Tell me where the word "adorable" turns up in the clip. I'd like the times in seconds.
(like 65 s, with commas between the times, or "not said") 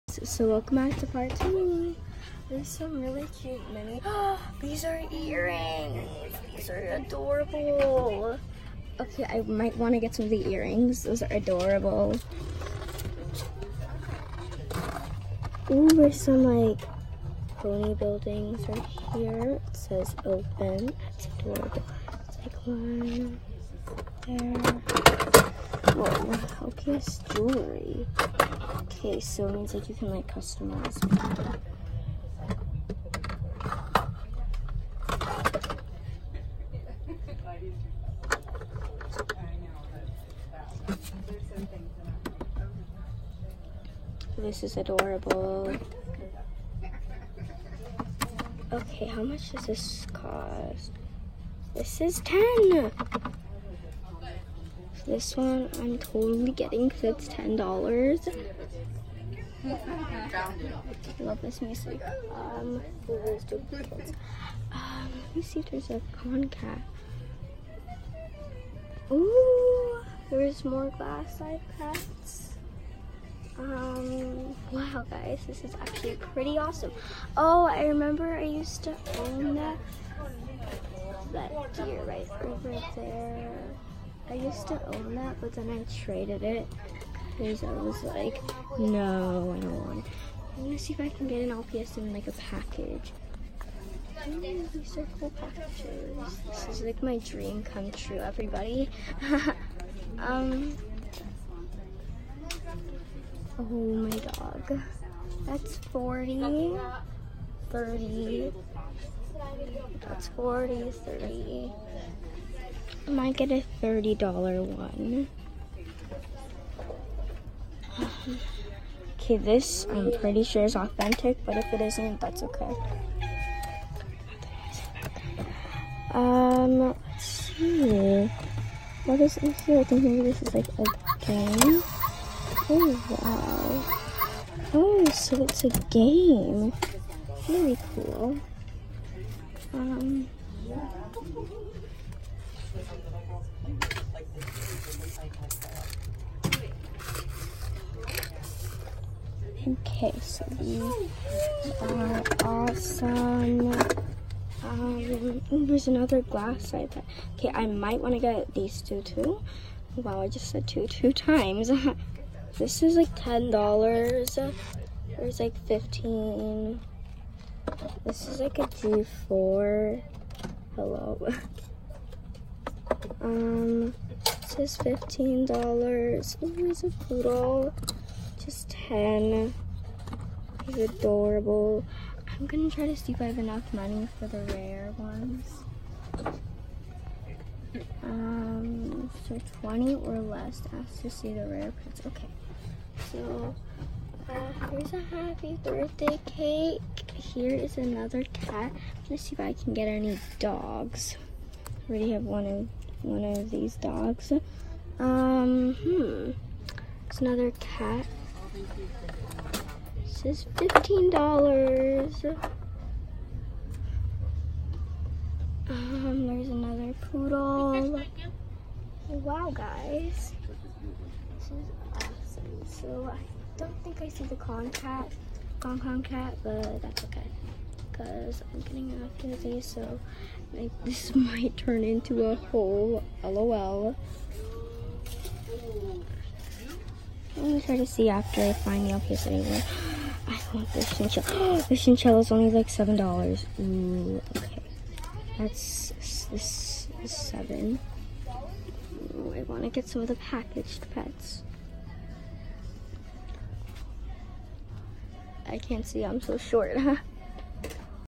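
6 s, 11 s, 21 s, 44 s, 180 s.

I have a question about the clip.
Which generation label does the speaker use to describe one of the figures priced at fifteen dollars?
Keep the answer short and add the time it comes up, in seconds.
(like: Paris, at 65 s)
G4, at 168 s.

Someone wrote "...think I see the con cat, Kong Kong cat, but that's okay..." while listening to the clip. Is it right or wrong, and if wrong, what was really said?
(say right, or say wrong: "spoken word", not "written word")
right.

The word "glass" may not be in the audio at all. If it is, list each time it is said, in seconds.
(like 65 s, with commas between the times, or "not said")
70 s, 156 s.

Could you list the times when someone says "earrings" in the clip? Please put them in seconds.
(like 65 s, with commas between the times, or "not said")
5 s, 10 s.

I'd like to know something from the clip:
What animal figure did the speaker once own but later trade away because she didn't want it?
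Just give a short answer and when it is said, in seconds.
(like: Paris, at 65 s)
Deer, at 81 s.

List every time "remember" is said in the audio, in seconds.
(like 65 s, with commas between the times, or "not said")
77 s.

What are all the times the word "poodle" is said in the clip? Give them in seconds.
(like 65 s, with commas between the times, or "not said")
177 s, 217 s.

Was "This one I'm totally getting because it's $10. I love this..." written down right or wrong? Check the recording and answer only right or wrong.
right.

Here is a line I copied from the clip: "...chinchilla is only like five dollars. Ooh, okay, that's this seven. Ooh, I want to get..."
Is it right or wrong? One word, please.
wrong.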